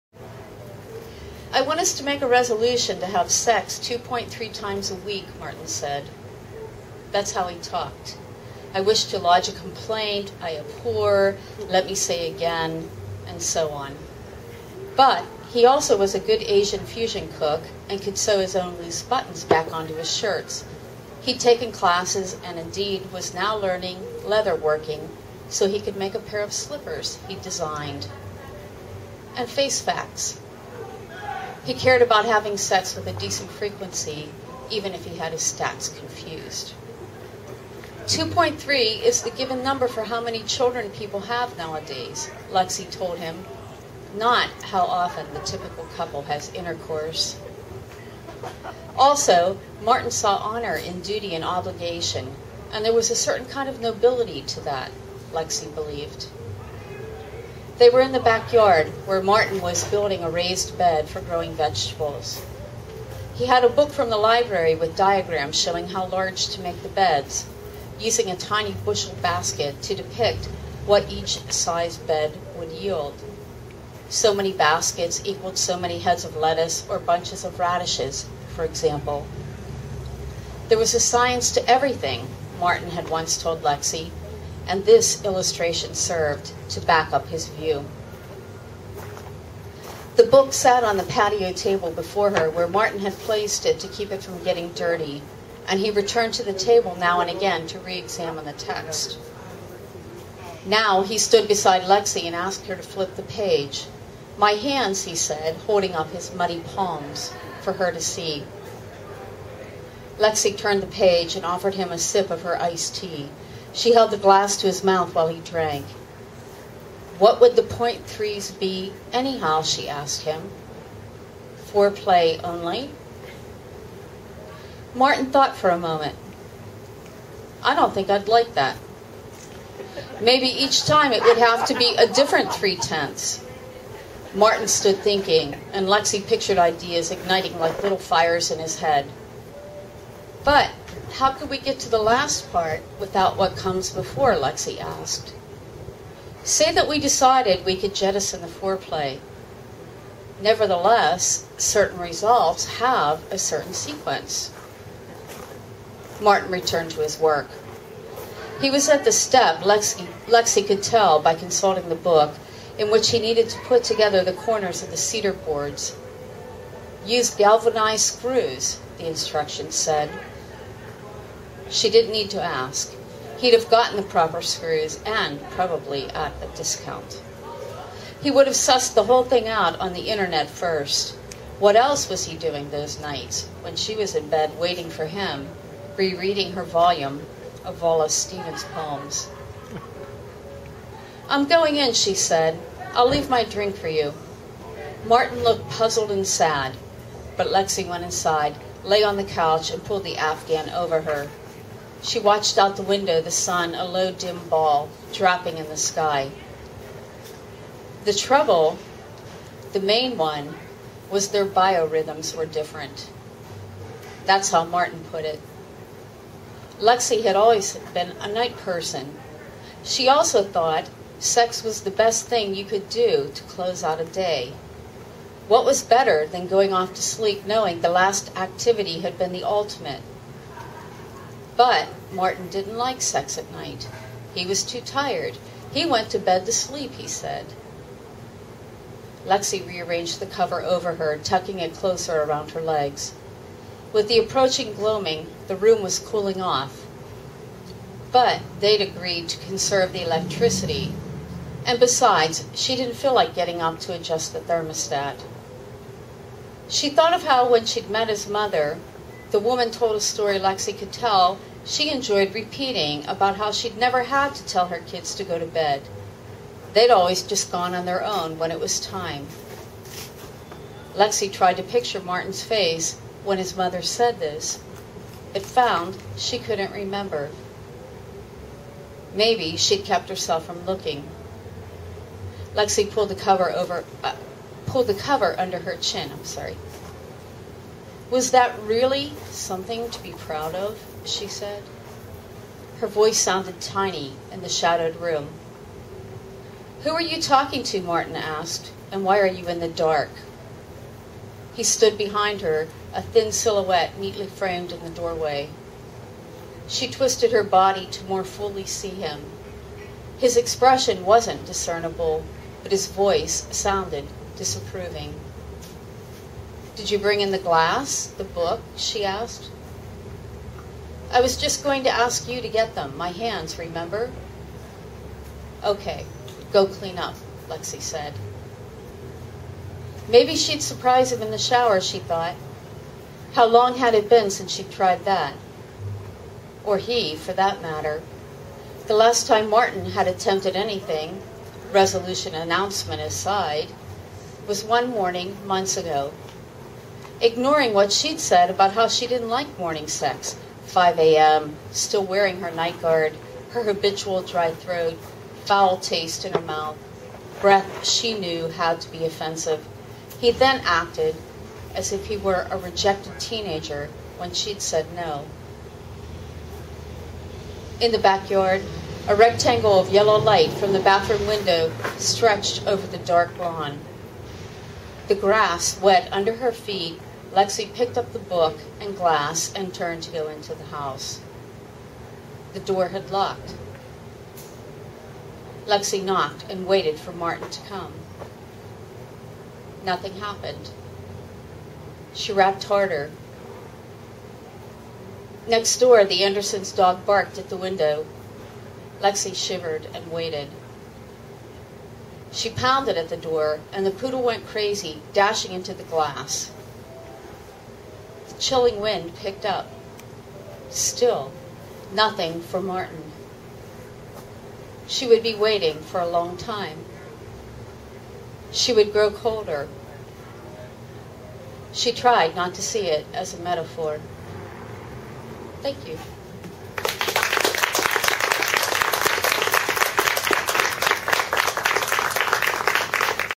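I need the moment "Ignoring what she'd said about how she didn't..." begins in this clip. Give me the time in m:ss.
5:47.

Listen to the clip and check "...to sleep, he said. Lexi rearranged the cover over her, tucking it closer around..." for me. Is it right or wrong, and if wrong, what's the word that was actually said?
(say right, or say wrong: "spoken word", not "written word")
right.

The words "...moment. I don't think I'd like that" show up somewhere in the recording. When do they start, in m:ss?
2:05.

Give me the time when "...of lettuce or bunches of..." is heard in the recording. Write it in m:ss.
1:16.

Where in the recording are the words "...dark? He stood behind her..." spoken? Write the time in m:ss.
4:59.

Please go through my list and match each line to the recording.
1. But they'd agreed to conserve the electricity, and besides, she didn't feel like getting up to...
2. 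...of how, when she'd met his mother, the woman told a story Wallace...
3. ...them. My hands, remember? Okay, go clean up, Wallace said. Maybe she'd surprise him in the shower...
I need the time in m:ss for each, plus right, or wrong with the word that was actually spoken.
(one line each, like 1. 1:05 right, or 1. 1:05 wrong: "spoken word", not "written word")
1. 4:08 right
2. 4:17 wrong: "Lexi", not "Wallace"
3. 5:22 wrong: "Lexi", not "Wallace".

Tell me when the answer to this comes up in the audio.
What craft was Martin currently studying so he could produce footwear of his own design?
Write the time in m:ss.
0:24.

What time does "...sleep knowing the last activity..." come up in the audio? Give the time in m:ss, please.
3:47.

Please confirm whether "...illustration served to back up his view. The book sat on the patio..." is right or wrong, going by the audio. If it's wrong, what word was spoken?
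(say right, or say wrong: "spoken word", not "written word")
right.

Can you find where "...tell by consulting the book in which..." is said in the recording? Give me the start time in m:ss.
2:40.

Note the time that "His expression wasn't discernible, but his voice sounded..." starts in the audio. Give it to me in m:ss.
5:10.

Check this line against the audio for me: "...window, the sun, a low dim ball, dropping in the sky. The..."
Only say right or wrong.
right.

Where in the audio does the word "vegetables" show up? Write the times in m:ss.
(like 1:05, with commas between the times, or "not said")
1:01.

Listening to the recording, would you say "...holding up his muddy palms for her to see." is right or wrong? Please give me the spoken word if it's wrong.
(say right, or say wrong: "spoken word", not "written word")
right.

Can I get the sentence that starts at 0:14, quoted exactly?
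But he also was a good Asian fusion cook and could sew his own loose buttons back onto his shirts.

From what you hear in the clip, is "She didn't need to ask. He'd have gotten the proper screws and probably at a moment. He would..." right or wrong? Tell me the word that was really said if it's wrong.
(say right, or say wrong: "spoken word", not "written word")
wrong: "discount", not "moment".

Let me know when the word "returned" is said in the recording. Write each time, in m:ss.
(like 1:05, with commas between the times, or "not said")
1:35, 2:36.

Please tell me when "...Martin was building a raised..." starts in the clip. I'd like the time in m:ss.
0:59.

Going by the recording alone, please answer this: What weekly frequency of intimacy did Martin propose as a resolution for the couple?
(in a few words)
2.3 times a week.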